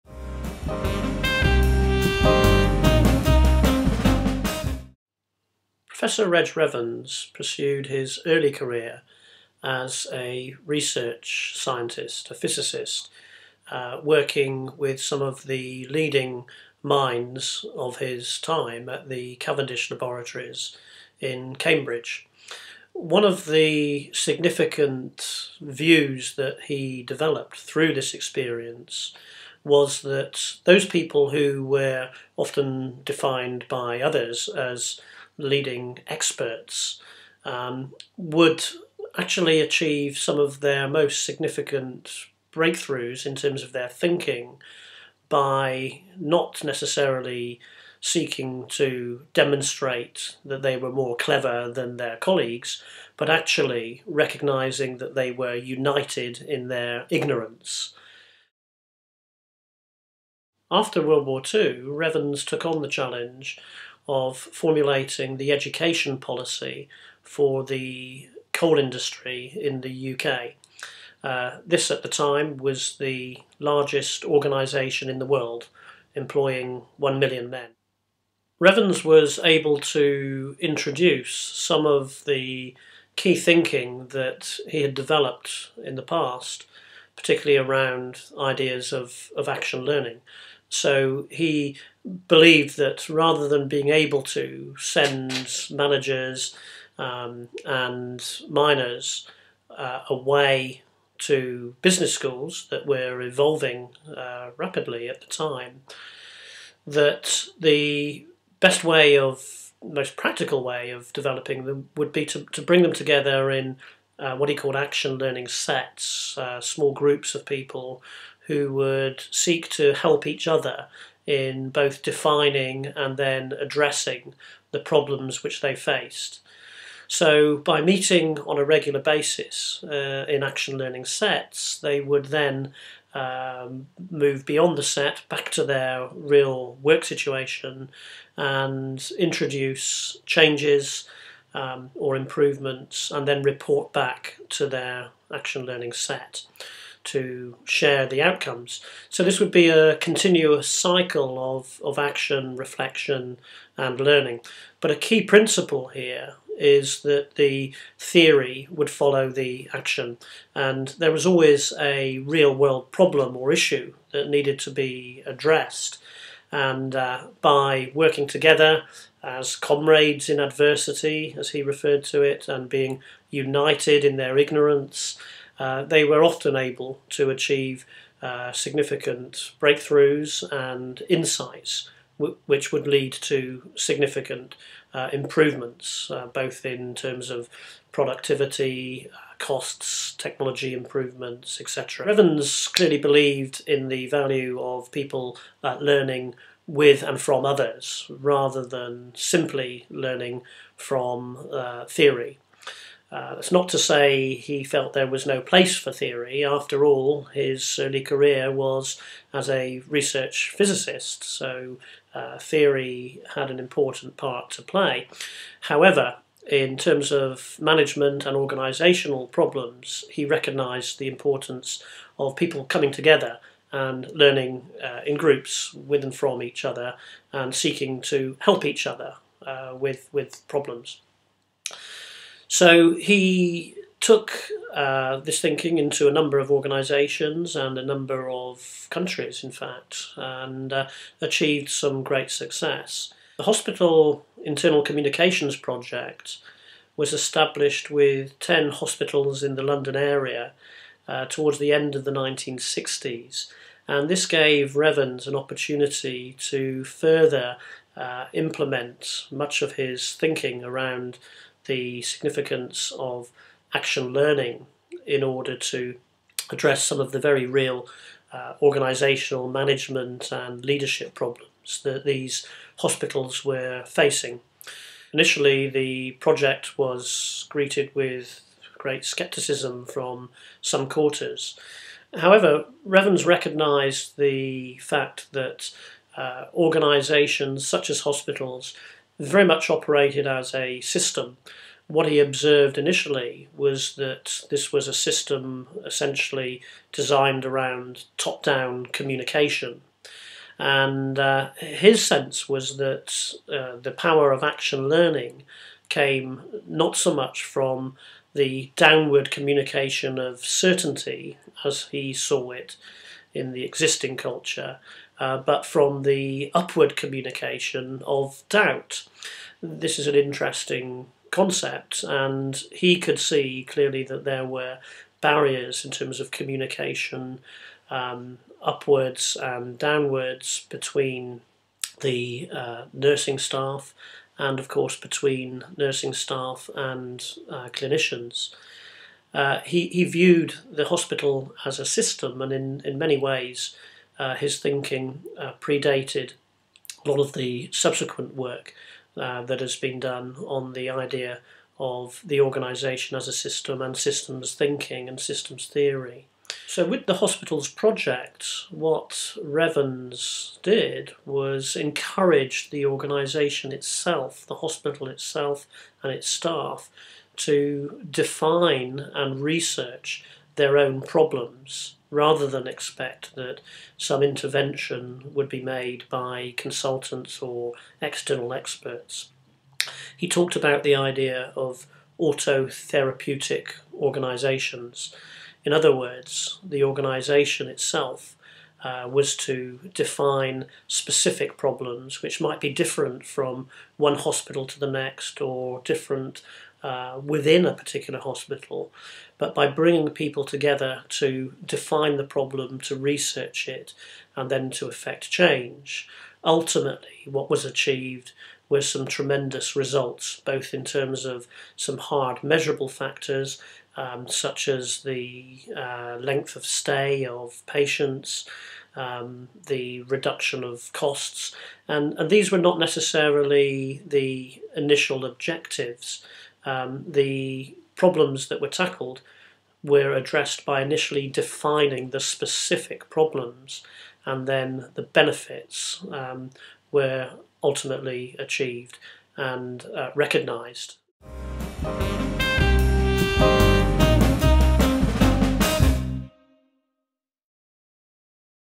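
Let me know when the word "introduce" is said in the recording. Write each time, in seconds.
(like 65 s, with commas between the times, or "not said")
80 s, 139 s.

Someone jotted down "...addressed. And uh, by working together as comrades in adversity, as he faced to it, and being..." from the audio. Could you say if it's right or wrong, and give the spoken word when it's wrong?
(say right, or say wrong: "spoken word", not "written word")
wrong: "referred", not "faced".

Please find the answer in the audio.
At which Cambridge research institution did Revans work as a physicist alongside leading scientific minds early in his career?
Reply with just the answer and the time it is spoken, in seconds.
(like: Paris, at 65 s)
Cavendish Laboratories, at 19 s.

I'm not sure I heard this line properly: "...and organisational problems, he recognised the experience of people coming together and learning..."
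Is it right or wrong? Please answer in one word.
wrong.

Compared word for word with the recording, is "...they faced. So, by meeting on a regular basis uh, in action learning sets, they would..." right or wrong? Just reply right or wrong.
right.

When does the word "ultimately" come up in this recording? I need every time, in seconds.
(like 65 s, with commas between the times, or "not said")
406 s, 437 s.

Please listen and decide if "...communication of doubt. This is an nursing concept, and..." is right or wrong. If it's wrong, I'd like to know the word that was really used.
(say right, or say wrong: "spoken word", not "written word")
wrong: "interesting", not "nursing".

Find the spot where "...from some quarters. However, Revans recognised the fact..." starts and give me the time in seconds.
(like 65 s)
279 s.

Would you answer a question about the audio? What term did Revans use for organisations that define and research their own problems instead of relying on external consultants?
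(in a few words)
autotherapeutic organisations.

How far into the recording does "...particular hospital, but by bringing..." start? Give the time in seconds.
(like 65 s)
397 s.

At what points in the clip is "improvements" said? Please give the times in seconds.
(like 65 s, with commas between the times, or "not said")
142 s, 185 s, 190 s.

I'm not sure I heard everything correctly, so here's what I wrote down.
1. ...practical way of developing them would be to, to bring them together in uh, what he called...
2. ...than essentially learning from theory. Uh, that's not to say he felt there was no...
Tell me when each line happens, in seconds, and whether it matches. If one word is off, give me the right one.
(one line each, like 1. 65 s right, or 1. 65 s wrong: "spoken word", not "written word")
1. 110 s right
2. 198 s wrong: "simply", not "essentially".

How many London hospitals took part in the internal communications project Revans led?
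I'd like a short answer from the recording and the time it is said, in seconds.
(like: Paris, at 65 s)
10, at 248 s.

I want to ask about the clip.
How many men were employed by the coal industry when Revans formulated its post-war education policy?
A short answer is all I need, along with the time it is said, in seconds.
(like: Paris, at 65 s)
1 million, at 76 s.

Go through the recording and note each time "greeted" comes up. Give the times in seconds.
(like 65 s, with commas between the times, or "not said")
277 s.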